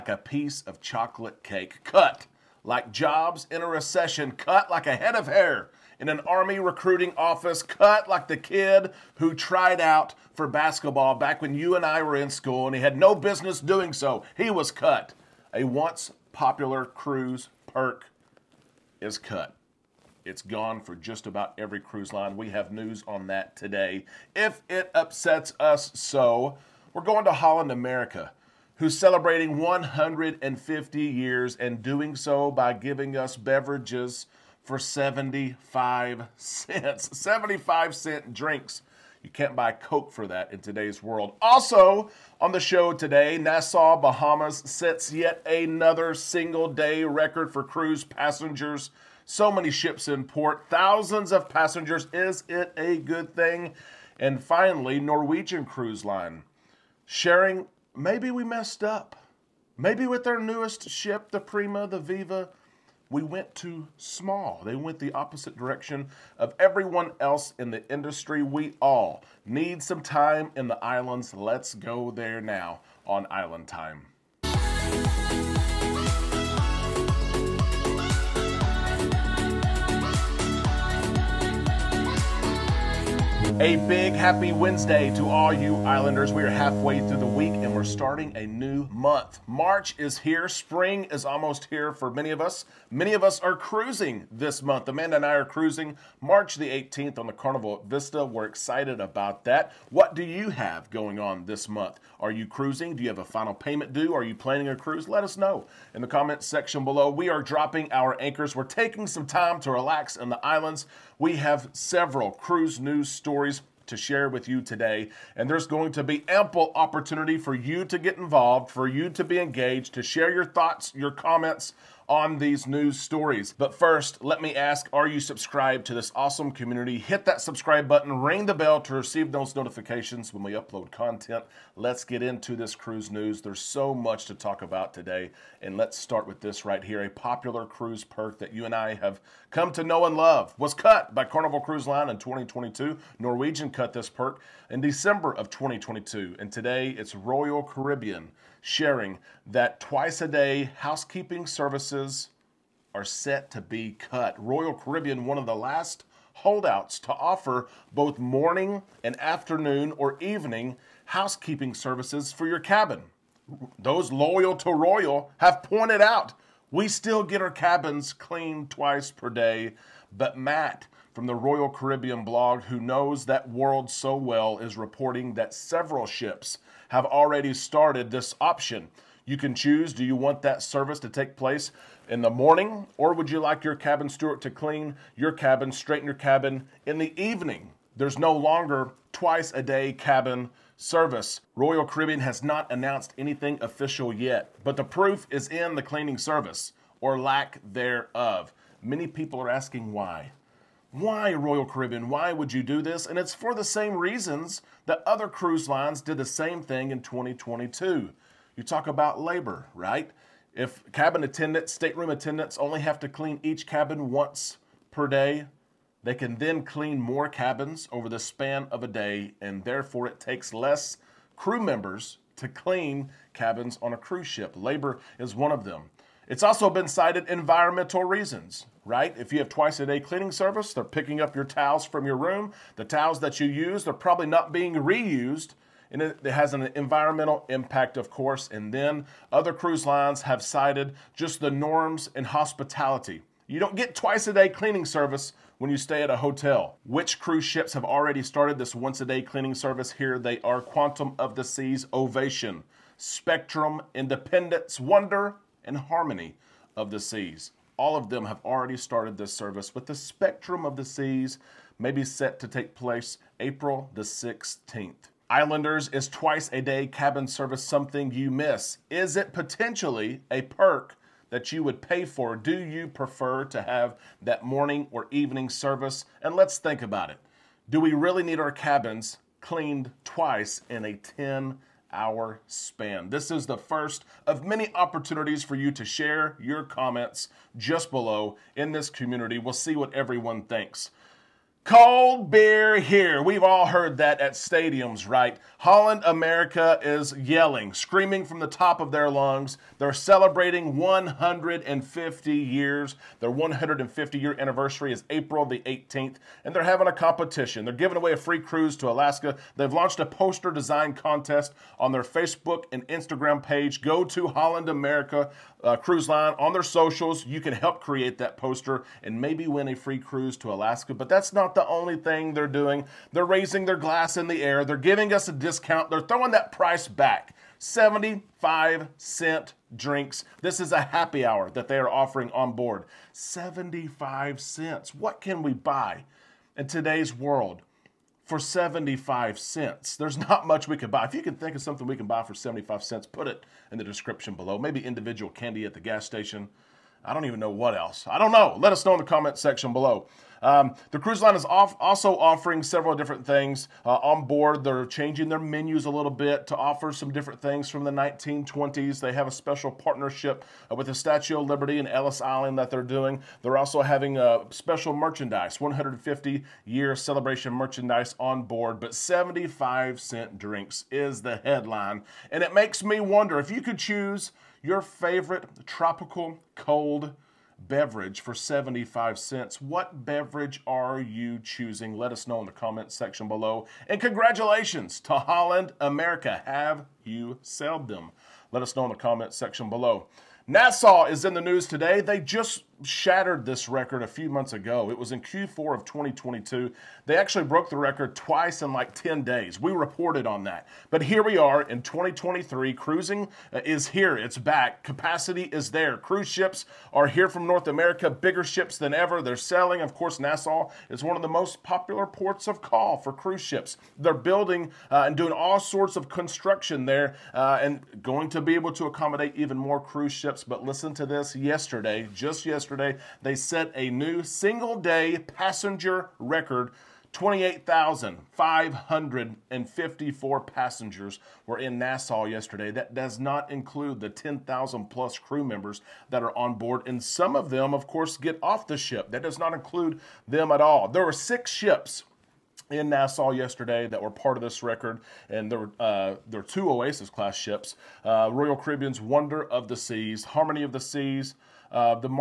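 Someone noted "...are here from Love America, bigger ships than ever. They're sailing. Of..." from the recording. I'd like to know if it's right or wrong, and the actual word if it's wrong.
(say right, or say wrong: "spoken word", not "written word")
wrong: "North", not "Love".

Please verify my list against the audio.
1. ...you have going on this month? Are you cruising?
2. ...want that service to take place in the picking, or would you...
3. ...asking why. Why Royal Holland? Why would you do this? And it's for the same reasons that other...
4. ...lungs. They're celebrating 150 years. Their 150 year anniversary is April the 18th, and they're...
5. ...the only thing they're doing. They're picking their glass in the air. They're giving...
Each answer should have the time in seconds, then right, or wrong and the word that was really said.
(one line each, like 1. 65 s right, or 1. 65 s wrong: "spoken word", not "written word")
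1. 100 s right
2. 180 s wrong: "morning", not "picking"
3. 199 s wrong: "Caribbean", not "Holland"
4. 299 s right
5. 321 s wrong: "raising", not "picking".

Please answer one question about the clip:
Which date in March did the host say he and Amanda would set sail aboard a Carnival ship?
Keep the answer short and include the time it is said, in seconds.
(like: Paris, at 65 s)
March 18, at 96 s.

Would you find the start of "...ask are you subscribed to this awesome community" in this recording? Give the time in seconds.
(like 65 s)
124 s.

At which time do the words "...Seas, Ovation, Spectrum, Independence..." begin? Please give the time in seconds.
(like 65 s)
251 s.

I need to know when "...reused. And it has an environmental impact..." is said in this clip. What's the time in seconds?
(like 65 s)
234 s.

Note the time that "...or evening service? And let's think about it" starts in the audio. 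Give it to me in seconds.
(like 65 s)
274 s.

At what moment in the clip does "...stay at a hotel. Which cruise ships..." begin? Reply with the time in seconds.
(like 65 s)
245 s.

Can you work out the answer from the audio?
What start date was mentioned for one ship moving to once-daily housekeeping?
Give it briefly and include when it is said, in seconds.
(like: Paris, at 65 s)
April 16, at 263 s.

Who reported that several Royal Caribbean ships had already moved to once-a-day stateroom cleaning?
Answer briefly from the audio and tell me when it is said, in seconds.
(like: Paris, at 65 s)
Matt, at 170 s.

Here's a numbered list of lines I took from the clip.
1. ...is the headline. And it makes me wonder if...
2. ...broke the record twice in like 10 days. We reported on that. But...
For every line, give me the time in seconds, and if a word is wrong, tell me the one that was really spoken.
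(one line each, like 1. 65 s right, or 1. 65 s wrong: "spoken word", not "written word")
1. 370 s right
2. 397 s right.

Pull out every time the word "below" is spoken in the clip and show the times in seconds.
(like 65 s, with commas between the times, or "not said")
106 s, 287 s, 344 s, 349 s, 383 s, 389 s.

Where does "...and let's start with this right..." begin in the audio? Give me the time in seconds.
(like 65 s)
135 s.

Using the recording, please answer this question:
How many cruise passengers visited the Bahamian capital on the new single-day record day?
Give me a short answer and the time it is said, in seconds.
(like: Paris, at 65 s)
28,554, at 427 s.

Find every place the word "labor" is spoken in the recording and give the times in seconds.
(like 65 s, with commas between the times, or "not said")
209 s, 224 s.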